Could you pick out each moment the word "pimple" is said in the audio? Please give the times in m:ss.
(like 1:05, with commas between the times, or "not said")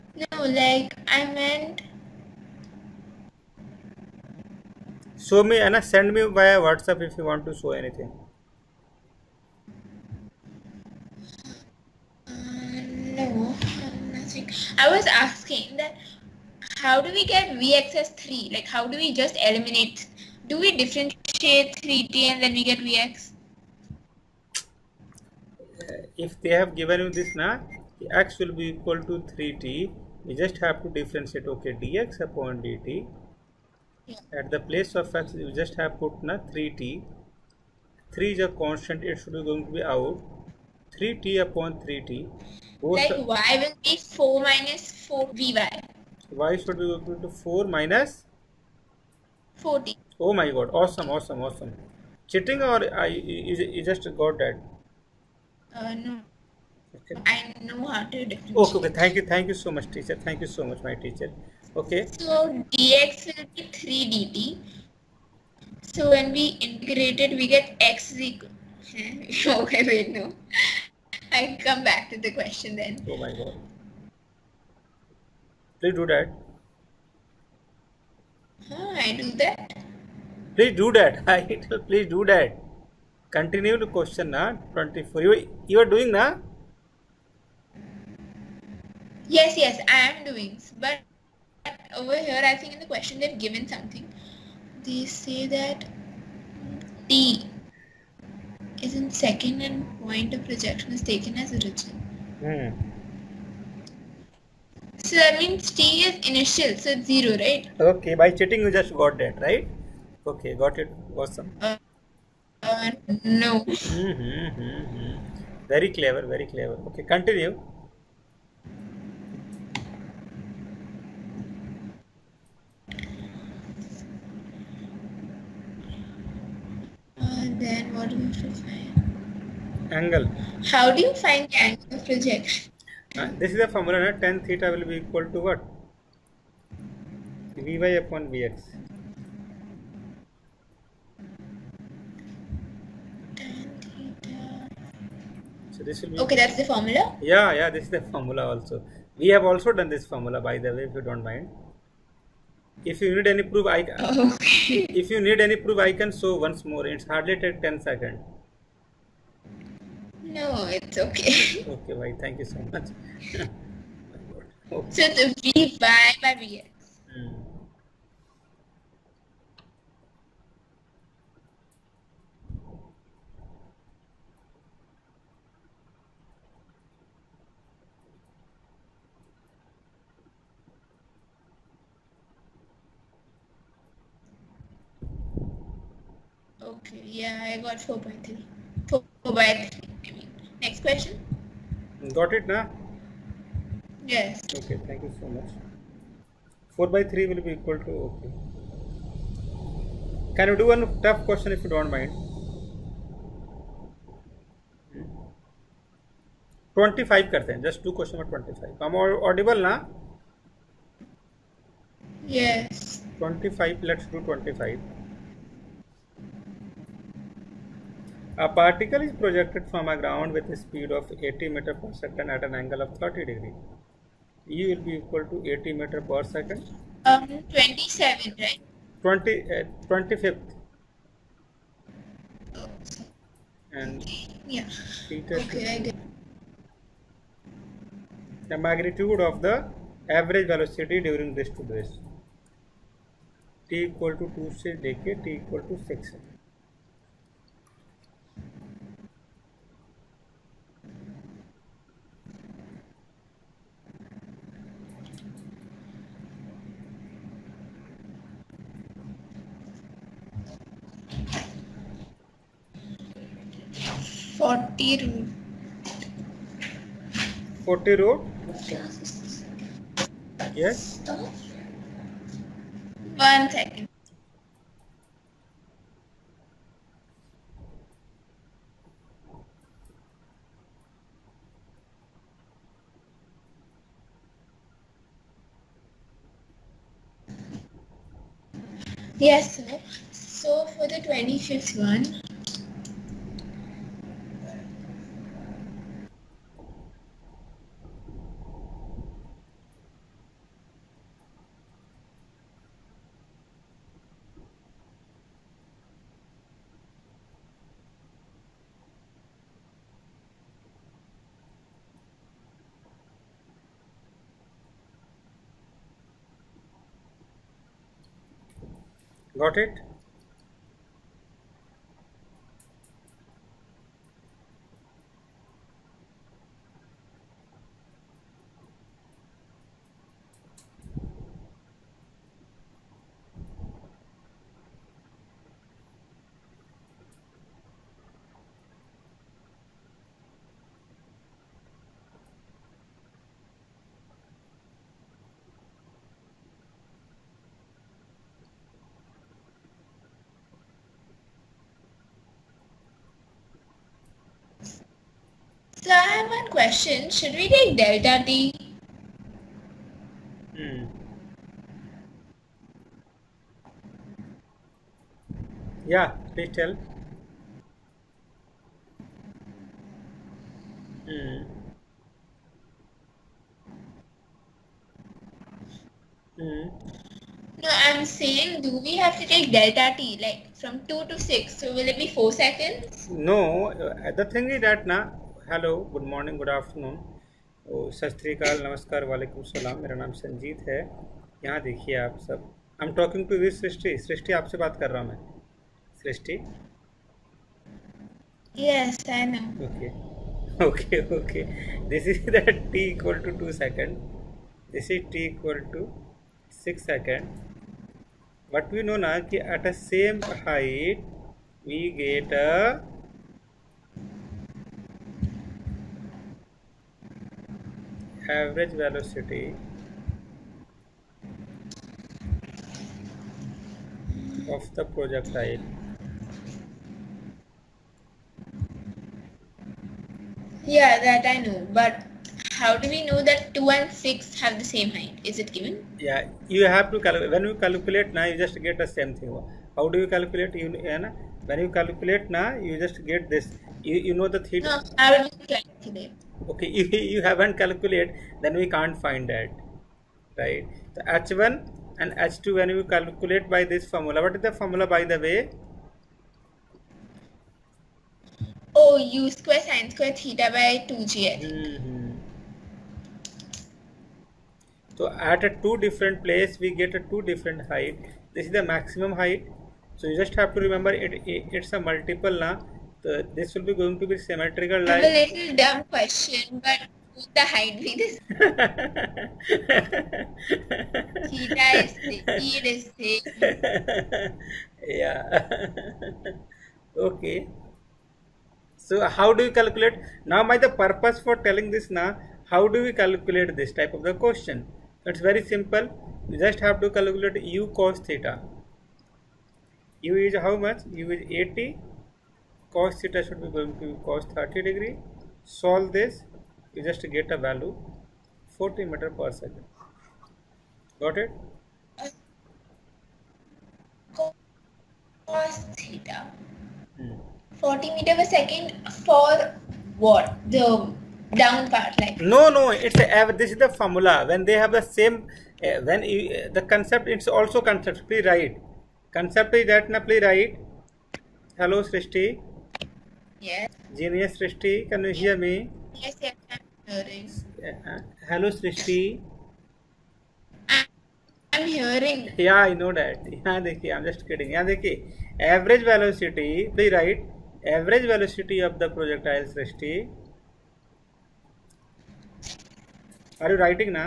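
not said.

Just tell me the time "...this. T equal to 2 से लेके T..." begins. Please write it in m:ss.
4:01.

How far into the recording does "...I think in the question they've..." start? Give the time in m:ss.
1:32.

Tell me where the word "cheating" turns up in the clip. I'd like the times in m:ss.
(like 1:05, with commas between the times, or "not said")
0:52, 1:48.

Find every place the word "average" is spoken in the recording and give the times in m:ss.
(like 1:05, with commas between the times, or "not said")
4:00, 6:58.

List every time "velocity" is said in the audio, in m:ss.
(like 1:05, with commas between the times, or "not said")
4:00, 6:58.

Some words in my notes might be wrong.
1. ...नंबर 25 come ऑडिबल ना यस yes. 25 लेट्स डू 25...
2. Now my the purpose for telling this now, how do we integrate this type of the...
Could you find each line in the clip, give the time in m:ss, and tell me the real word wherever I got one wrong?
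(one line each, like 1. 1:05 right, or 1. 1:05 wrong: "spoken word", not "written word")
1. 3:28 right
2. 8:10 wrong: "calculate", not "integrate".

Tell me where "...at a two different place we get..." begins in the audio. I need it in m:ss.
7:45.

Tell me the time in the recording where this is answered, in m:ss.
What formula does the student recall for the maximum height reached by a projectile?
7:38.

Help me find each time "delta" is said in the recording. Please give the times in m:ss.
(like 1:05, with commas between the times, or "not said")
5:57, 6:19.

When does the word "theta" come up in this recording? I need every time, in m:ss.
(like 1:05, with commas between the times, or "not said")
2:14, 3:55, 7:24, 7:40, 8:01, 8:18, 8:23, 8:35.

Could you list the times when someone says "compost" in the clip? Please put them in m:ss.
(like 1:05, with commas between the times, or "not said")
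not said.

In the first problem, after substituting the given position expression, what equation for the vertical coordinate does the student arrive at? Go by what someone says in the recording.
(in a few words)
y = 4 - 4t.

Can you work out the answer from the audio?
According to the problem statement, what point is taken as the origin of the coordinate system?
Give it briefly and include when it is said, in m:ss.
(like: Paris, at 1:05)
Point of projection, at 1:40.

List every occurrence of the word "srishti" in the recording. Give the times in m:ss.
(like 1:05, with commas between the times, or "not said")
8:51.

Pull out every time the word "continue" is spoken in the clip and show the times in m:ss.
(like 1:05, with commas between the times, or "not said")
1:23, 1:57.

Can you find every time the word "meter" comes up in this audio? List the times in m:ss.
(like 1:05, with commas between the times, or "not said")
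3:41, 3:45, 8:28, 8:37.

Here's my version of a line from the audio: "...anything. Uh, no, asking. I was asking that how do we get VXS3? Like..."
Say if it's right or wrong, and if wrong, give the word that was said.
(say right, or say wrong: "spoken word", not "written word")
wrong: "nothing", not "asking".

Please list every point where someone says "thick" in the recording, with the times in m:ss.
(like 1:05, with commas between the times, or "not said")
8:01.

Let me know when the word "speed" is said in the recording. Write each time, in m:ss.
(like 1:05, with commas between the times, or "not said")
3:40.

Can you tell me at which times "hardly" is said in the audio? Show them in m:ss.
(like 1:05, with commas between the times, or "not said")
2:37.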